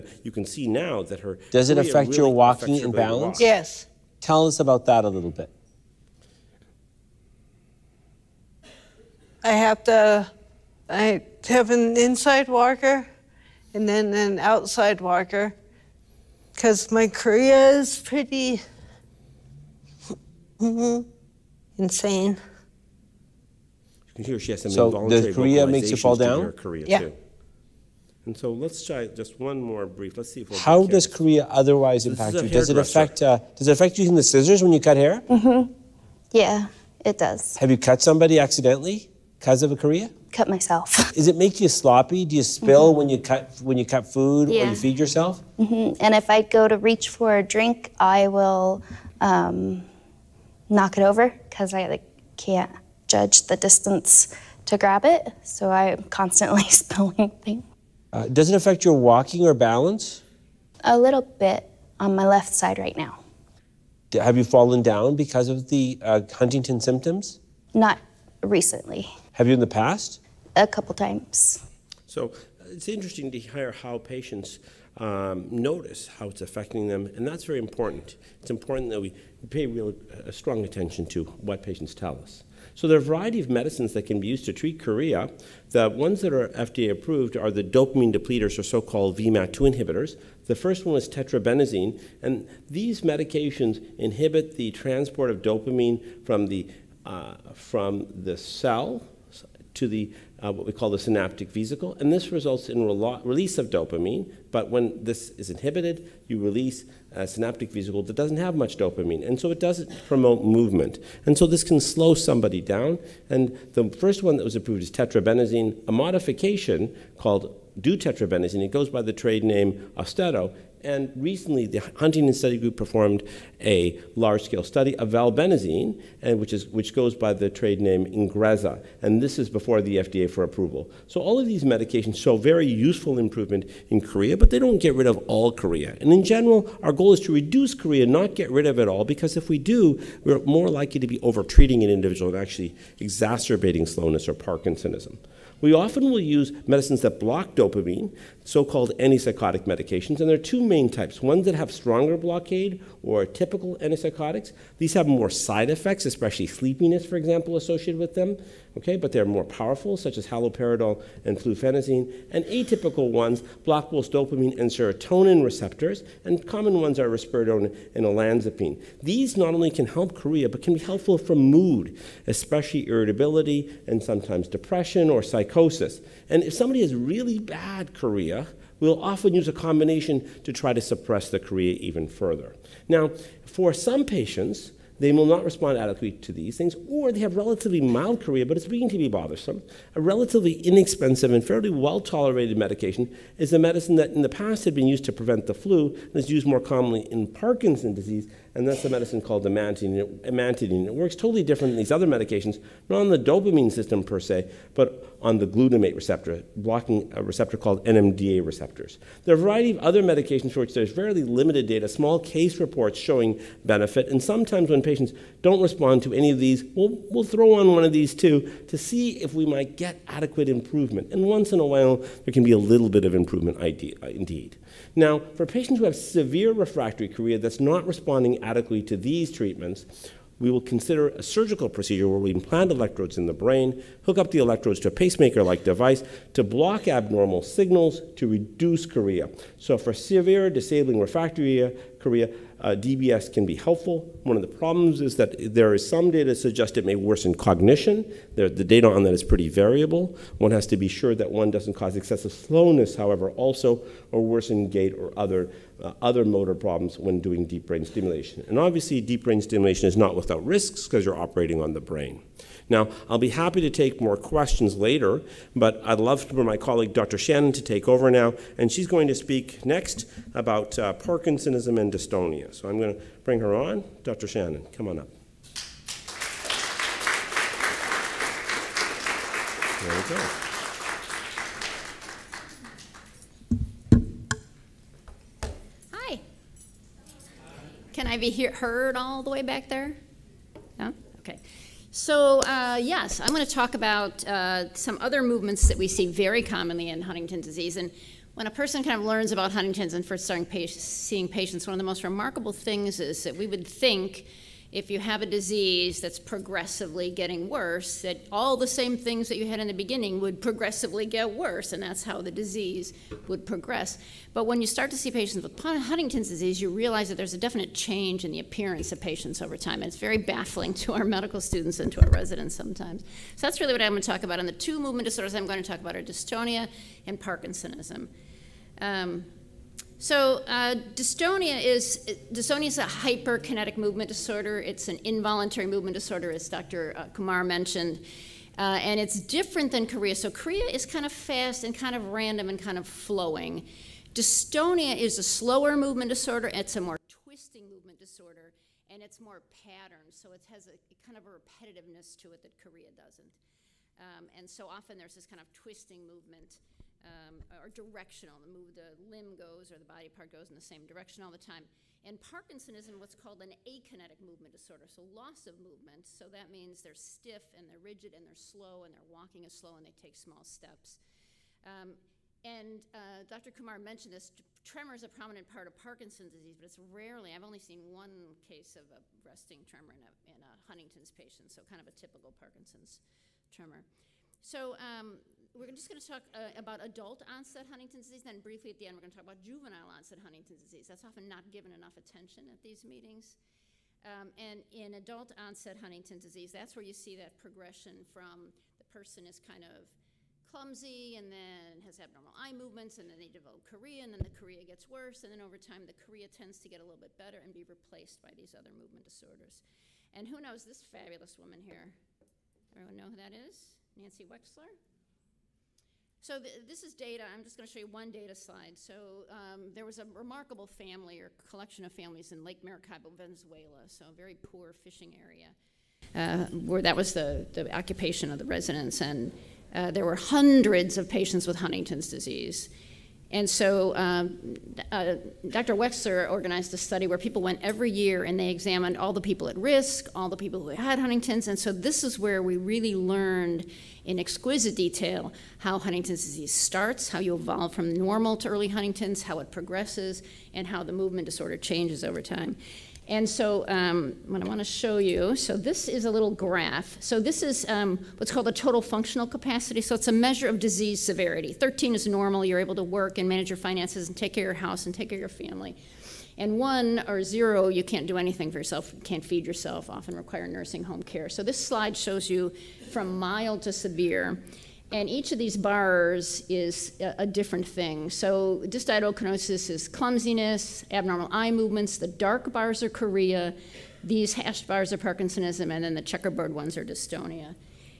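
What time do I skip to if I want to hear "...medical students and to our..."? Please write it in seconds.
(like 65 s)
321 s.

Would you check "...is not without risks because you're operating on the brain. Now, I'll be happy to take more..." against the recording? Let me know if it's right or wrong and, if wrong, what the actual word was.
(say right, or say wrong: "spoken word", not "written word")
right.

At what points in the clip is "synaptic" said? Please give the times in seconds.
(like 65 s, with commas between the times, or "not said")
100 s, 107 s.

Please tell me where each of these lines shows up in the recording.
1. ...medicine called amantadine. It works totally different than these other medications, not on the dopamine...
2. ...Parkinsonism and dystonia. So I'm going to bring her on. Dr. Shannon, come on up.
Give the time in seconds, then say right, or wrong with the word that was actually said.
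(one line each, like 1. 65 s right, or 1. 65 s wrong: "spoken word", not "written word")
1. 198 s right
2. 270 s right.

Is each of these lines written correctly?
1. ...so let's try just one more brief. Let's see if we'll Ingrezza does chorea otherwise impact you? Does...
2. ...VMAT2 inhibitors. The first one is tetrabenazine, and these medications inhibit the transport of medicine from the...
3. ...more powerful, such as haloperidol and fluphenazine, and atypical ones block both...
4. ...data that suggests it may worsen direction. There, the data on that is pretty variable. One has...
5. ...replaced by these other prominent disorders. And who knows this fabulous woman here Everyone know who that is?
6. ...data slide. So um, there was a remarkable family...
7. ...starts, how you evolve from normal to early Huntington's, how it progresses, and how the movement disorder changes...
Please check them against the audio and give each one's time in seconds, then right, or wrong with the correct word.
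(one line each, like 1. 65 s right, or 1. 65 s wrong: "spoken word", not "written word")
1. 28 s wrong: "How", not "Ingrezza"
2. 89 s wrong: "dopamine", not "medicine"
3. 159 s right
4. 246 s wrong: "cognition", not "direction"
5. 407 s wrong: "movement", not "prominent"
6. 418 s right
7. 446 s right.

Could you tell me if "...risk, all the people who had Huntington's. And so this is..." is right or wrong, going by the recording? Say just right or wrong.
right.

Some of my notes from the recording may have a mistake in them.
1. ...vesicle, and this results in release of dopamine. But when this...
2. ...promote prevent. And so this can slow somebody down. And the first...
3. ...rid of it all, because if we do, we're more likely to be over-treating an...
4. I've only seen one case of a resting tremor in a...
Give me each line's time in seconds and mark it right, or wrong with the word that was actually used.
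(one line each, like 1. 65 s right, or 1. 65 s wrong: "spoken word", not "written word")
1. 101 s right
2. 110 s wrong: "movement", not "prevent"
3. 138 s right
4. 377 s right.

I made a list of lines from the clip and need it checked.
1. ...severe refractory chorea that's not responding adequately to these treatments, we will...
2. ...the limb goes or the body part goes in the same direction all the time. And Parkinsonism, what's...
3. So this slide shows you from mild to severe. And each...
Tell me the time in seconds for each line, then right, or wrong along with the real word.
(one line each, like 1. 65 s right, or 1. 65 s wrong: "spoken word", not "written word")
1. 225 s right
2. 358 s right
3. 471 s right.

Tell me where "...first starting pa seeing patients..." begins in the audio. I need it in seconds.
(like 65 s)
300 s.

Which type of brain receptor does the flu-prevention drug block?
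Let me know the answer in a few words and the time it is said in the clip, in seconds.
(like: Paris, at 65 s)
NMDA receptors, at 207 s.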